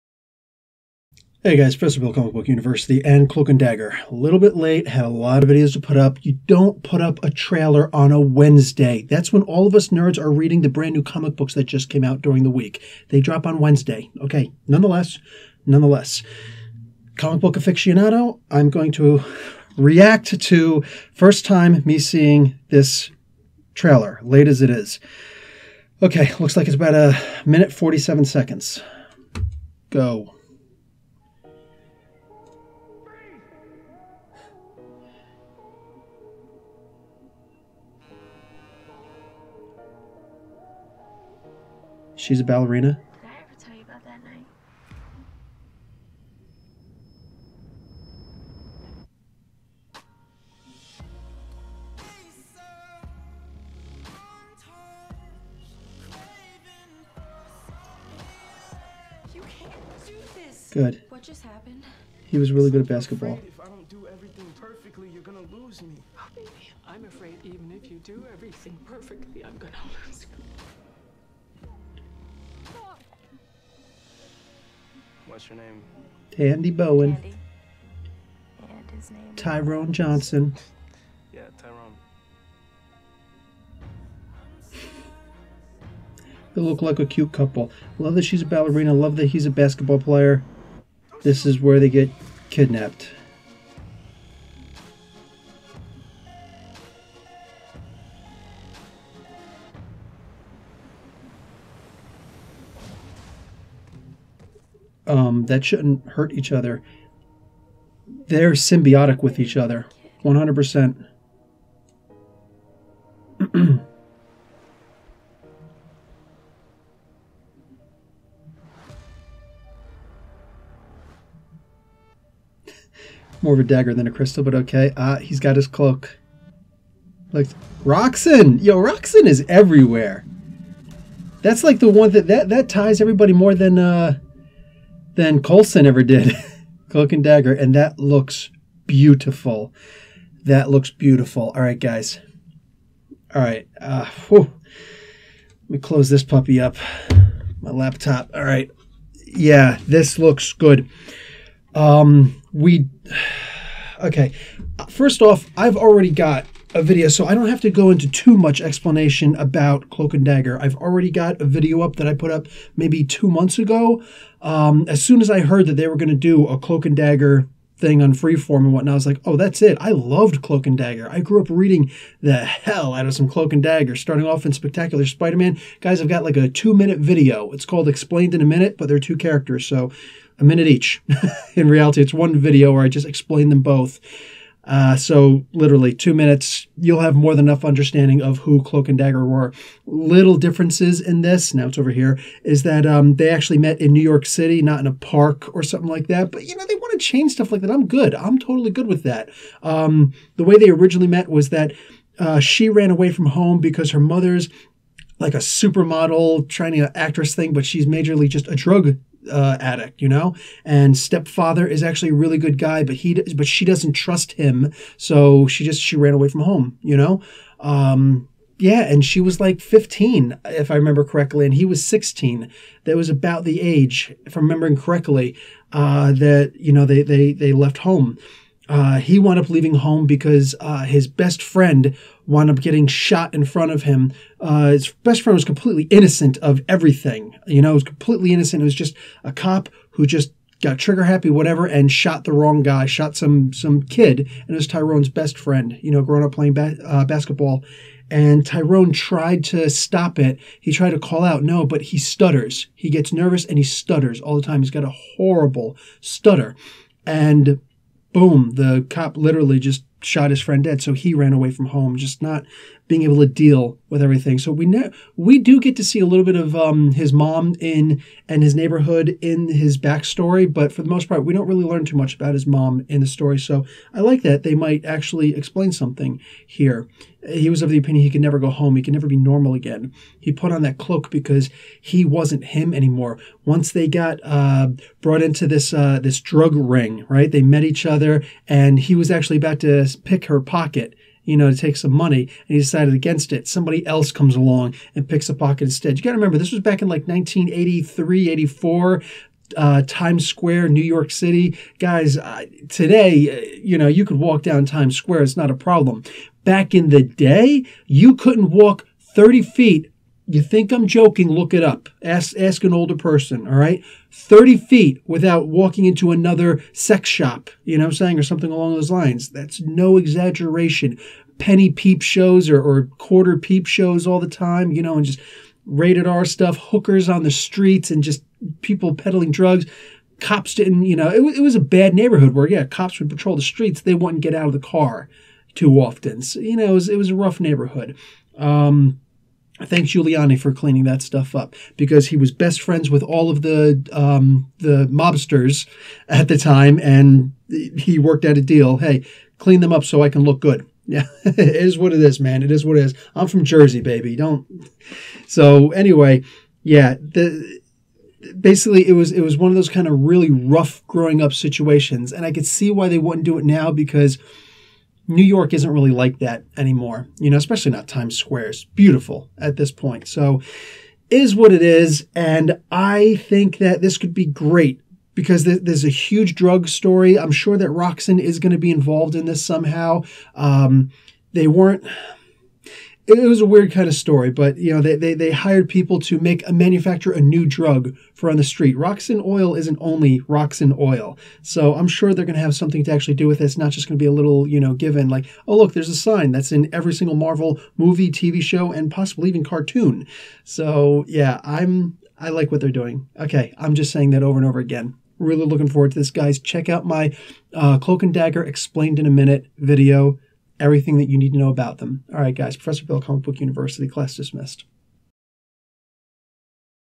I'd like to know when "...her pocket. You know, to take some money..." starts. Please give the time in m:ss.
4:50.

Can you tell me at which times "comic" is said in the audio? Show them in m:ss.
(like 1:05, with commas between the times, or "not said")
0:02, 0:11, 0:17, 6:53.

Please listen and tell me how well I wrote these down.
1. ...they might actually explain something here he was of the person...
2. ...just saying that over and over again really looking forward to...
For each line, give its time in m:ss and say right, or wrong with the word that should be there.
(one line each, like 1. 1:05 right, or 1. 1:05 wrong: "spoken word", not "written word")
1. 4:34 wrong: "opinion", not "person"
2. 6:43 right.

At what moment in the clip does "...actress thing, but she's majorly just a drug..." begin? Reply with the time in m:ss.
3:26.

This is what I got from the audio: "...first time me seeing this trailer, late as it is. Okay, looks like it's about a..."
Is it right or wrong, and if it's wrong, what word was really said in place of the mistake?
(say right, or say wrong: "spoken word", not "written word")
right.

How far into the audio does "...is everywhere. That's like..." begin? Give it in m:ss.
2:09.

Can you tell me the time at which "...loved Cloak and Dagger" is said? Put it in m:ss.
2:49.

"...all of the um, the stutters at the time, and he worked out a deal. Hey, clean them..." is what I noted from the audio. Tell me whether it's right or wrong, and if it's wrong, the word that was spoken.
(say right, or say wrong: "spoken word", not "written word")
wrong: "mobsters", not "stutters".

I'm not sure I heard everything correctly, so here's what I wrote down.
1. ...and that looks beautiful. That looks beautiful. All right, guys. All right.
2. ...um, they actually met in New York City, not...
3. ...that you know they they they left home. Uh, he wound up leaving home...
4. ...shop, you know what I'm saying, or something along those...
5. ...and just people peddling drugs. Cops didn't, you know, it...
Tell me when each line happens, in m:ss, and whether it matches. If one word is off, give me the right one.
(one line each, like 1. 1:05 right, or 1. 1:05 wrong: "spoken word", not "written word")
1. 2:17 right
2. 3:12 right
3. 3:46 right
4. 5:17 right
5. 5:27 right.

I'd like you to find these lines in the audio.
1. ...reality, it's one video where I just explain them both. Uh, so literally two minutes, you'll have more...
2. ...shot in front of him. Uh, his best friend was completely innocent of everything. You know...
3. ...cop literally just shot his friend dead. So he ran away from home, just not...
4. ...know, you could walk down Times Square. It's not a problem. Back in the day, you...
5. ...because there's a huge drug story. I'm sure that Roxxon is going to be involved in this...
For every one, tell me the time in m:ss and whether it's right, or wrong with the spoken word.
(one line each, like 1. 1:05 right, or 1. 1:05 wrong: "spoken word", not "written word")
1. 3:01 right
2. 3:52 right
3. 4:18 right
4. 5:03 right
5. 6:15 right.